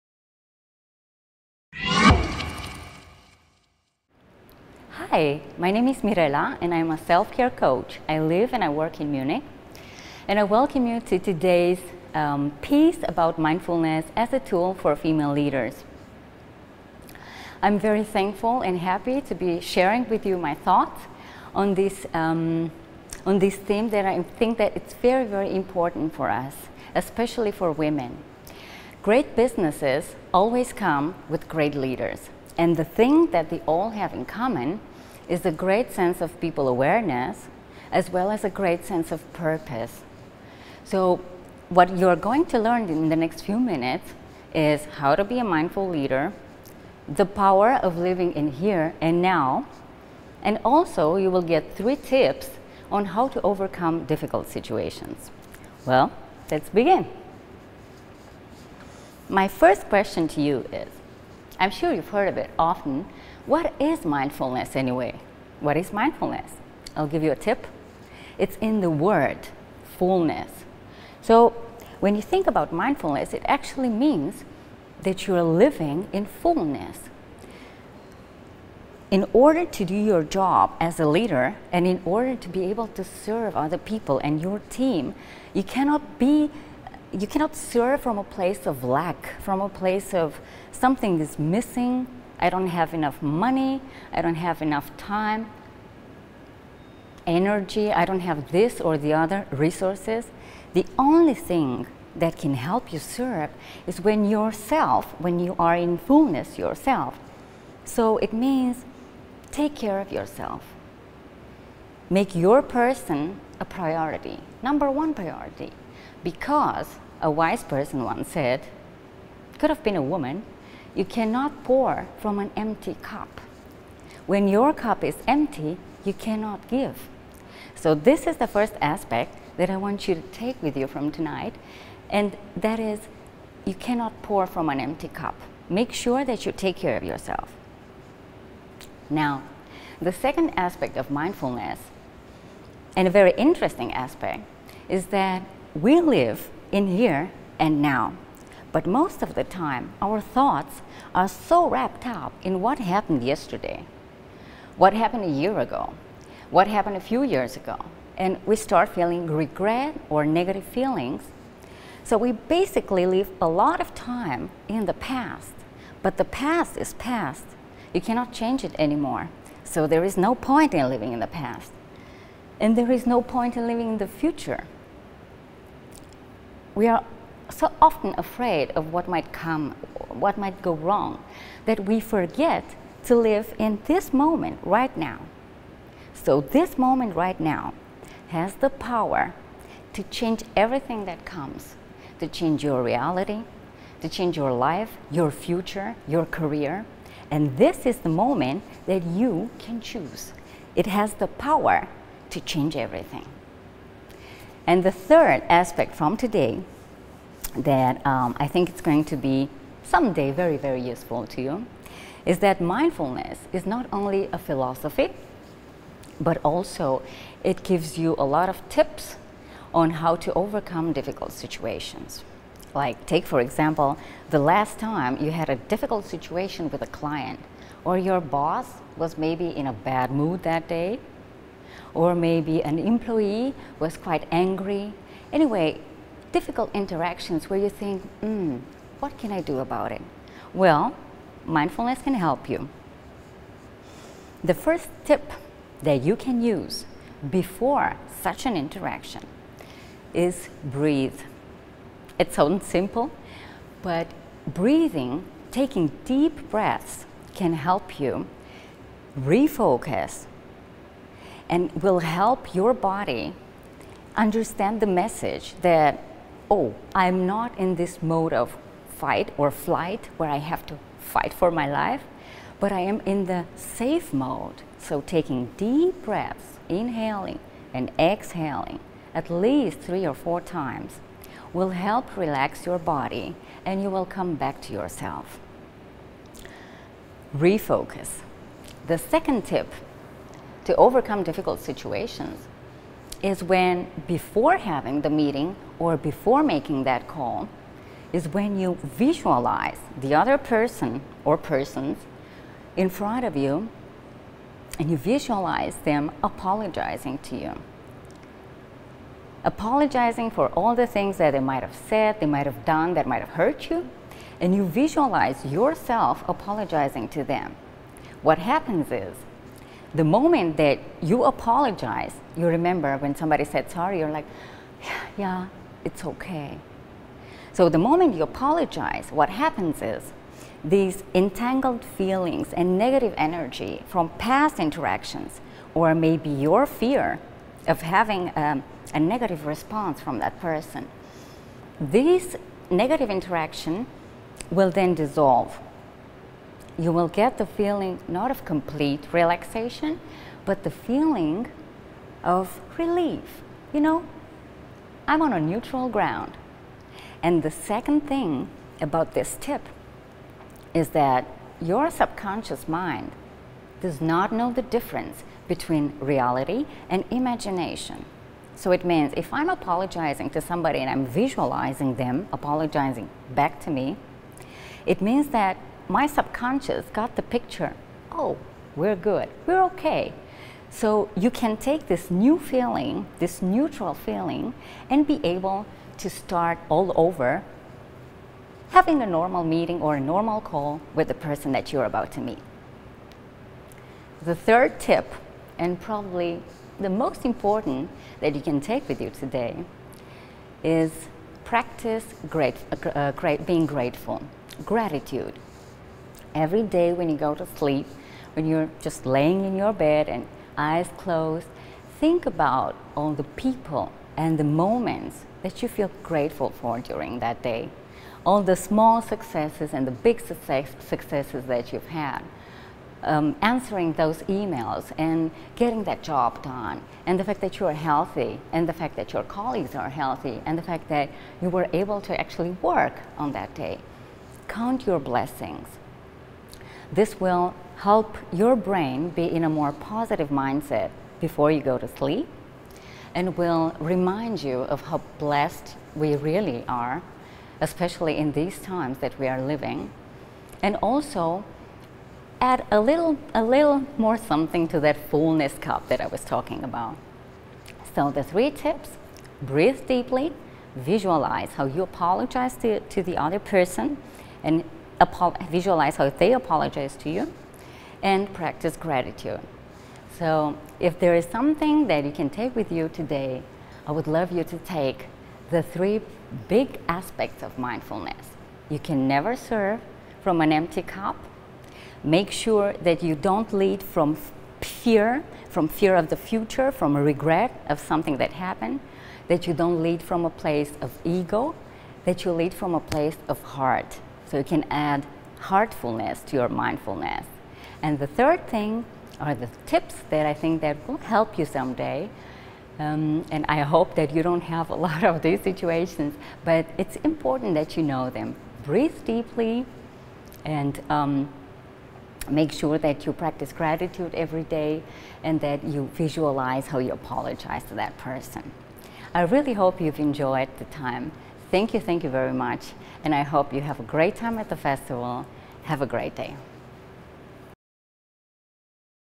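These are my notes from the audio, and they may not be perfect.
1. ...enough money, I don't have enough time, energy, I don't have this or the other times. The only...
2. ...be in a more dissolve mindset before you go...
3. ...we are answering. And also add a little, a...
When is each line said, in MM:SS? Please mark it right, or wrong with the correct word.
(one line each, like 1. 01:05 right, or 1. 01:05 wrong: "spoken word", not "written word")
1. 01:32 wrong: "resources", not "times"
2. 07:19 wrong: "positive", not "dissolve"
3. 07:29 wrong: "living", not "answering".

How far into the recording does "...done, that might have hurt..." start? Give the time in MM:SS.
05:12.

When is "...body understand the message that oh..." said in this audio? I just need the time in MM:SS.
04:22.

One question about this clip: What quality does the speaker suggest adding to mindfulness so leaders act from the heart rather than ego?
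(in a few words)
heartfulness.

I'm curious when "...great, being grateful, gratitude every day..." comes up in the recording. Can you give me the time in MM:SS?
06:43.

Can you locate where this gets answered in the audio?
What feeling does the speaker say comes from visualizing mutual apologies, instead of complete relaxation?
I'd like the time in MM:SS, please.
05:52.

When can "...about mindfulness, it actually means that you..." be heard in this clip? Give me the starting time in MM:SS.
01:12.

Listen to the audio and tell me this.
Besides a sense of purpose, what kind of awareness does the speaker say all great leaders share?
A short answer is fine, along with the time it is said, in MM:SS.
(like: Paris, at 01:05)
people awareness, at 00:36.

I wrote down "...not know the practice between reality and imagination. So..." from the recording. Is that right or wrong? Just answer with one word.
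wrong.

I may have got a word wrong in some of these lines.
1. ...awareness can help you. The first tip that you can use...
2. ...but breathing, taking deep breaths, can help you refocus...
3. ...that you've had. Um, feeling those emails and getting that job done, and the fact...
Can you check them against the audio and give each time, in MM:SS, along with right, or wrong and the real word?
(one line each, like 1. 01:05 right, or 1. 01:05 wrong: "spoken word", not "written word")
1. 04:01 wrong: "mindfulness", not "awareness"
2. 04:13 right
3. 07:01 wrong: "answering", not "feeling".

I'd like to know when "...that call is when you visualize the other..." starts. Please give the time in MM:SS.
04:56.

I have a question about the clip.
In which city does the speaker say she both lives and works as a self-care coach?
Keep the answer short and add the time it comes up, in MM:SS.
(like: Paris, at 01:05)
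Munich, at 00:09.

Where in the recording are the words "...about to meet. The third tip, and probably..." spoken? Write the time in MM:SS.
06:31.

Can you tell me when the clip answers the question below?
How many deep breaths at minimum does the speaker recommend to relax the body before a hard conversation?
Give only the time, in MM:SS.
04:39.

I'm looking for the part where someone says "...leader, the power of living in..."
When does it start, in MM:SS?
00:45.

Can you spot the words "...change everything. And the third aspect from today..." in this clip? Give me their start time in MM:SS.
03:22.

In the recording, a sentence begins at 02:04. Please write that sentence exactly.
When your cup is empty, you cannot give.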